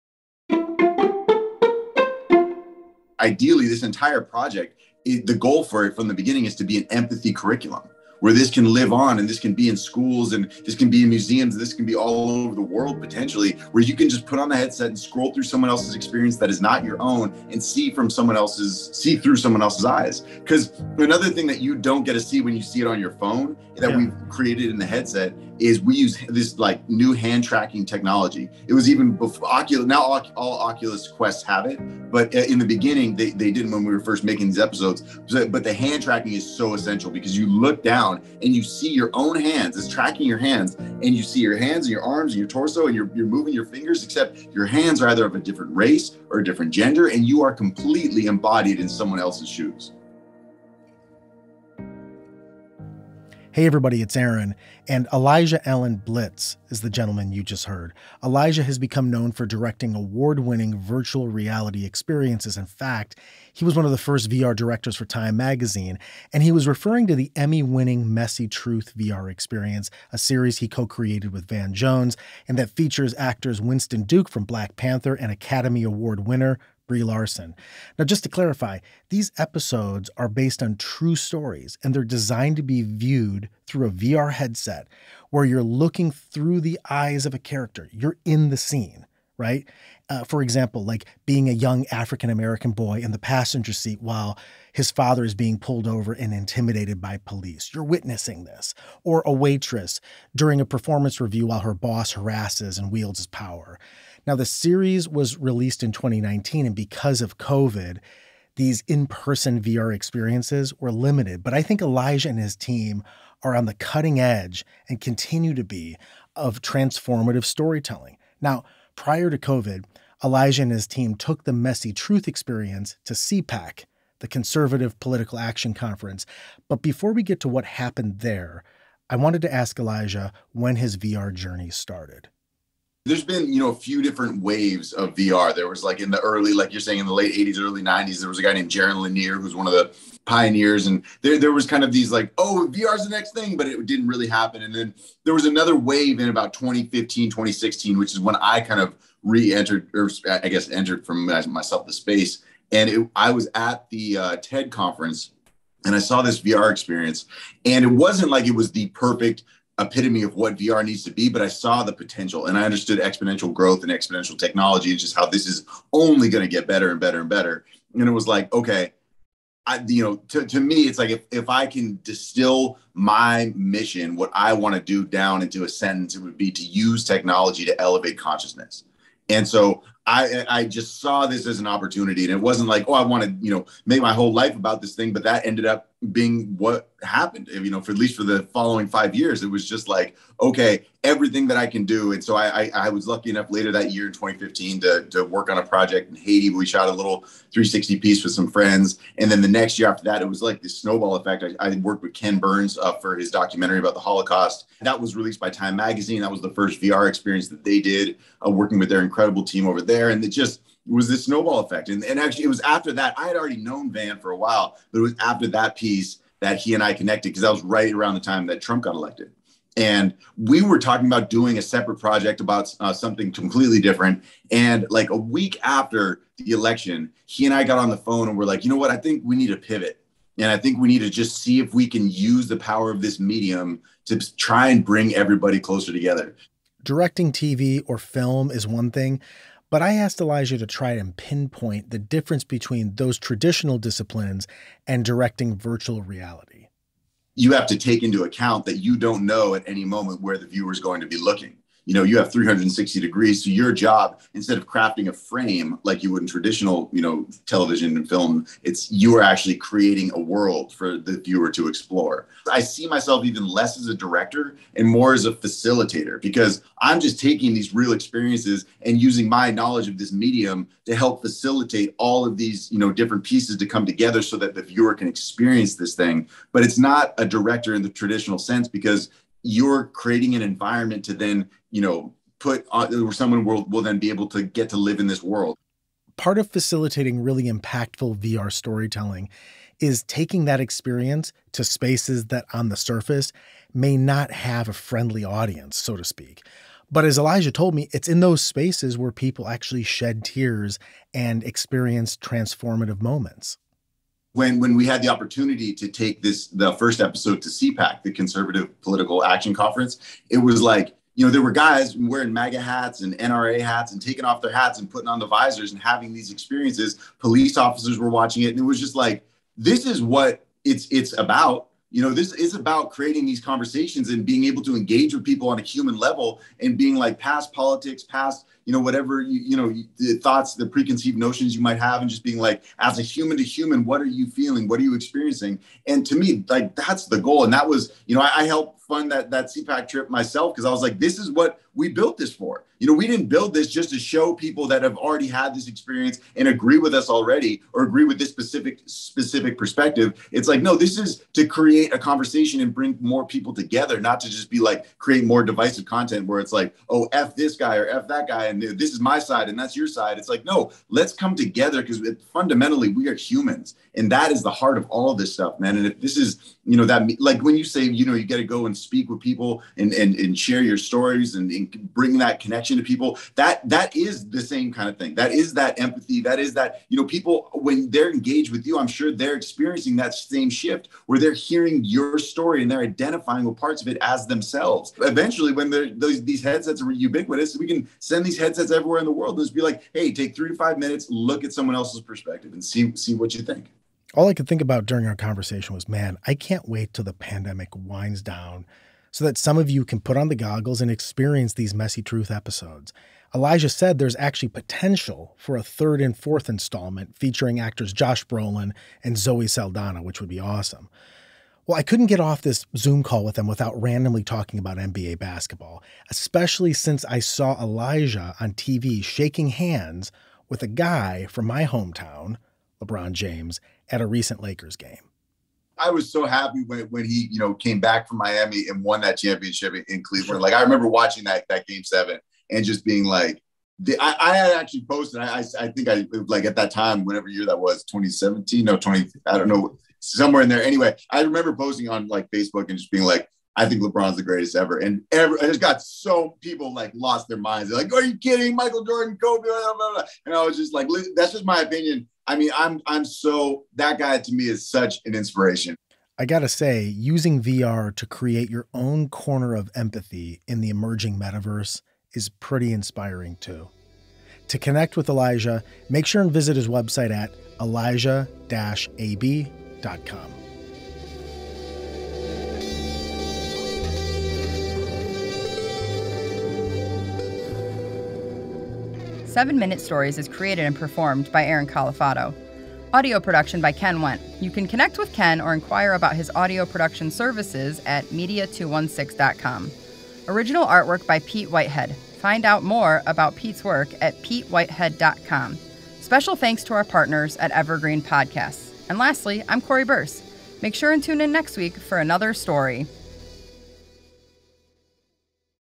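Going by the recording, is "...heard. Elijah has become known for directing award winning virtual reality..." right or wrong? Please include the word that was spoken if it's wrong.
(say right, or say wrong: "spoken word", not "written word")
right.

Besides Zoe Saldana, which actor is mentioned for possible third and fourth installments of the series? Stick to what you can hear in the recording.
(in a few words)
Josh Brolin.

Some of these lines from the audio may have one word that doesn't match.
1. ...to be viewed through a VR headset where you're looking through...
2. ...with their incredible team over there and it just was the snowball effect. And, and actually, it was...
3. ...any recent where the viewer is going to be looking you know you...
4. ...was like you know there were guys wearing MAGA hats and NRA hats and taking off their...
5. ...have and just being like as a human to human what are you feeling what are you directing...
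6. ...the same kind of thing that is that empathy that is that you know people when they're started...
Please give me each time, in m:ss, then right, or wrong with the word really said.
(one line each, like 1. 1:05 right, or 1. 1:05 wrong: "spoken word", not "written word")
1. 1:22 right
2. 3:28 right
3. 4:09 wrong: "moment", not "recent"
4. 5:10 right
5. 5:31 wrong: "experiencing", not "directing"
6. 6:14 wrong: "engaged", not "started".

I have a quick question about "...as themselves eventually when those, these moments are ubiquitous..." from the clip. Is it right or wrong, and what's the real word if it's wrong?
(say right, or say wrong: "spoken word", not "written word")
wrong: "headsets", not "moments".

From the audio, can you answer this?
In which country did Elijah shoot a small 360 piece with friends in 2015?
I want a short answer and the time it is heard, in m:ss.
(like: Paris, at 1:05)
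Haiti, at 3:16.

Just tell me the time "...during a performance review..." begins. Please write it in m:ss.
1:40.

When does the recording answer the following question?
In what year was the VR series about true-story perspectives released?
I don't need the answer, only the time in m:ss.
1:45.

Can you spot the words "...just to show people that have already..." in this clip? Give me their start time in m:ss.
5:43.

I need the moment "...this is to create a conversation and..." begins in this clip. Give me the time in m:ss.
5:50.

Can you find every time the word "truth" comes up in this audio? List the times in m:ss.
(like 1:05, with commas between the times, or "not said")
1:08, 2:01, 6:42.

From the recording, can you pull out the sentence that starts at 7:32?
I mean, I'm I'm so that guy to me is such an inspiration.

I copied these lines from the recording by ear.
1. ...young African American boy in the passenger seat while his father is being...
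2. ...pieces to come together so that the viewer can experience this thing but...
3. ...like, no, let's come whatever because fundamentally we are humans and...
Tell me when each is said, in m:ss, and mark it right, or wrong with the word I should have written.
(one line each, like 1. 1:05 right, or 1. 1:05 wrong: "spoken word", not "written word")
1. 1:31 right
2. 4:33 right
3. 6:00 wrong: "together", not "whatever".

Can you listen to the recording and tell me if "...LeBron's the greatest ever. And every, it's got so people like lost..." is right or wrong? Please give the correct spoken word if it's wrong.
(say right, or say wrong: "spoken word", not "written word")
right.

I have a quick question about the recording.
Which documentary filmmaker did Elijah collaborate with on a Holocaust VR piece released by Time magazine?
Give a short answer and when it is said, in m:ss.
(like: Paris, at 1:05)
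Ken Burns, at 3:22.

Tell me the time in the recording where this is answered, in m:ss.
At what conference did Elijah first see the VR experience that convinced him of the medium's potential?
2:34.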